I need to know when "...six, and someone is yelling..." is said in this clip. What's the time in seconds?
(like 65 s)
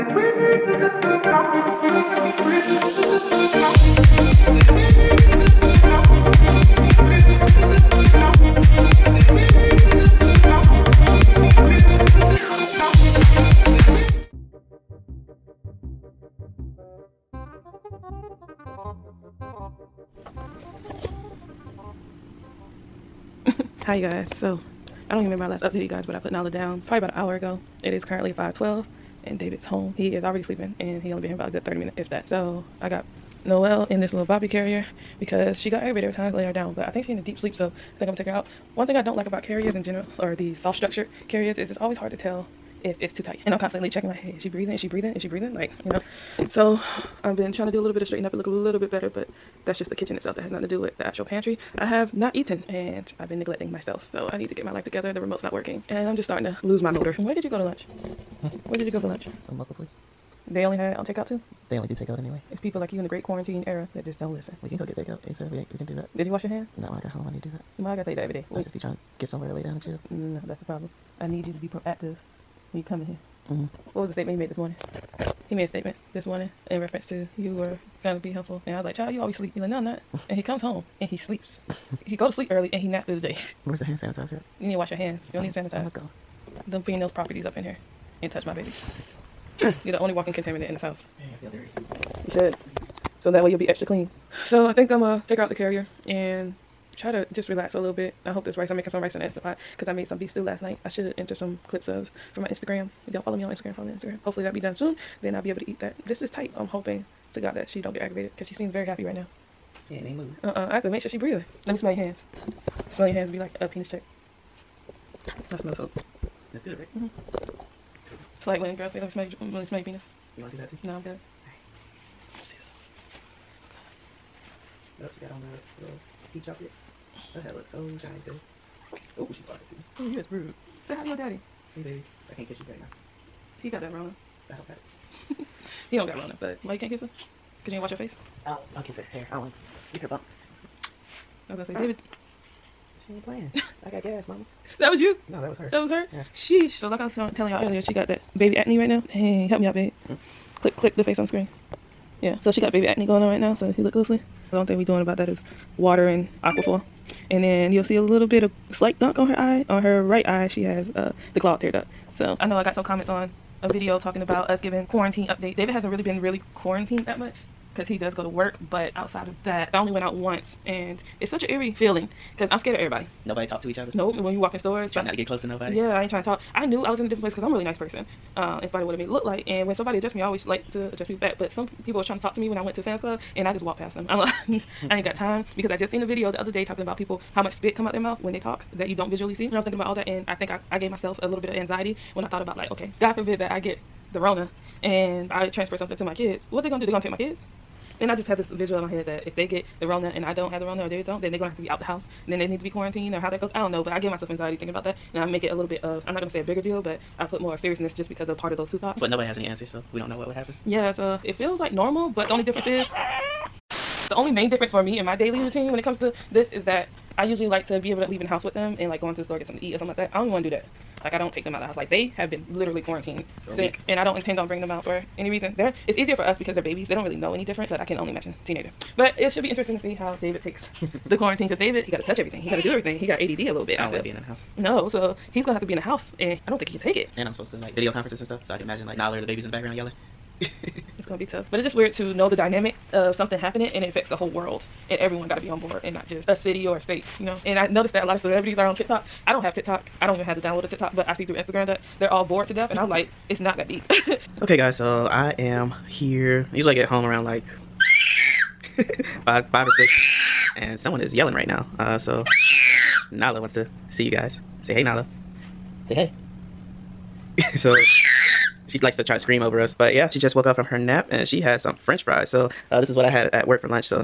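259 s.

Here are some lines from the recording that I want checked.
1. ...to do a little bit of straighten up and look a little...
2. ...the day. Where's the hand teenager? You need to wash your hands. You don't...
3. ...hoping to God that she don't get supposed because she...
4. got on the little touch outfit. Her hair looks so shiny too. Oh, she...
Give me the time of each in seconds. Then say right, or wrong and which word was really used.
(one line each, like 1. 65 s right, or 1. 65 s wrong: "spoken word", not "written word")
1. 47 s right
2. 83 s wrong: "sanitizer", not "teenager"
3. 106 s wrong: "aggravated", not "supposed"
4. 125 s wrong: "peach", not "touch".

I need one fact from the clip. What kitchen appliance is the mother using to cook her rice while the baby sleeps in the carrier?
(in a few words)
Instant Pot.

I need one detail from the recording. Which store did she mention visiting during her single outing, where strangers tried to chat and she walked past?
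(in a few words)
Sam's Club.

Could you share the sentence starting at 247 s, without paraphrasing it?
And I noticed that a lot of celebrities are on TikTok.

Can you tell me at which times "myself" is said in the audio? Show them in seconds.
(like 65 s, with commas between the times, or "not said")
53 s, 190 s, 204 s.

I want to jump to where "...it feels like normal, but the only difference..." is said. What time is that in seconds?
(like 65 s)
211 s.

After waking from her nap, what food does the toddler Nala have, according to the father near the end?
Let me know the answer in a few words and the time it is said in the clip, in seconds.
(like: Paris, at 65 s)
French fries, at 271 s.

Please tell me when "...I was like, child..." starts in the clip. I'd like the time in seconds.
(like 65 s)
78 s.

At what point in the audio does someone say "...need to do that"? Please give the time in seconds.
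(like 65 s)
67 s.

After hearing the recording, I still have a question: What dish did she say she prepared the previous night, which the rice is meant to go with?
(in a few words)
Beef stew.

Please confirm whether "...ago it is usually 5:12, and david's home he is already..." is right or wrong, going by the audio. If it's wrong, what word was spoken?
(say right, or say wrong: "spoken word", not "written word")
wrong: "currently", not "usually".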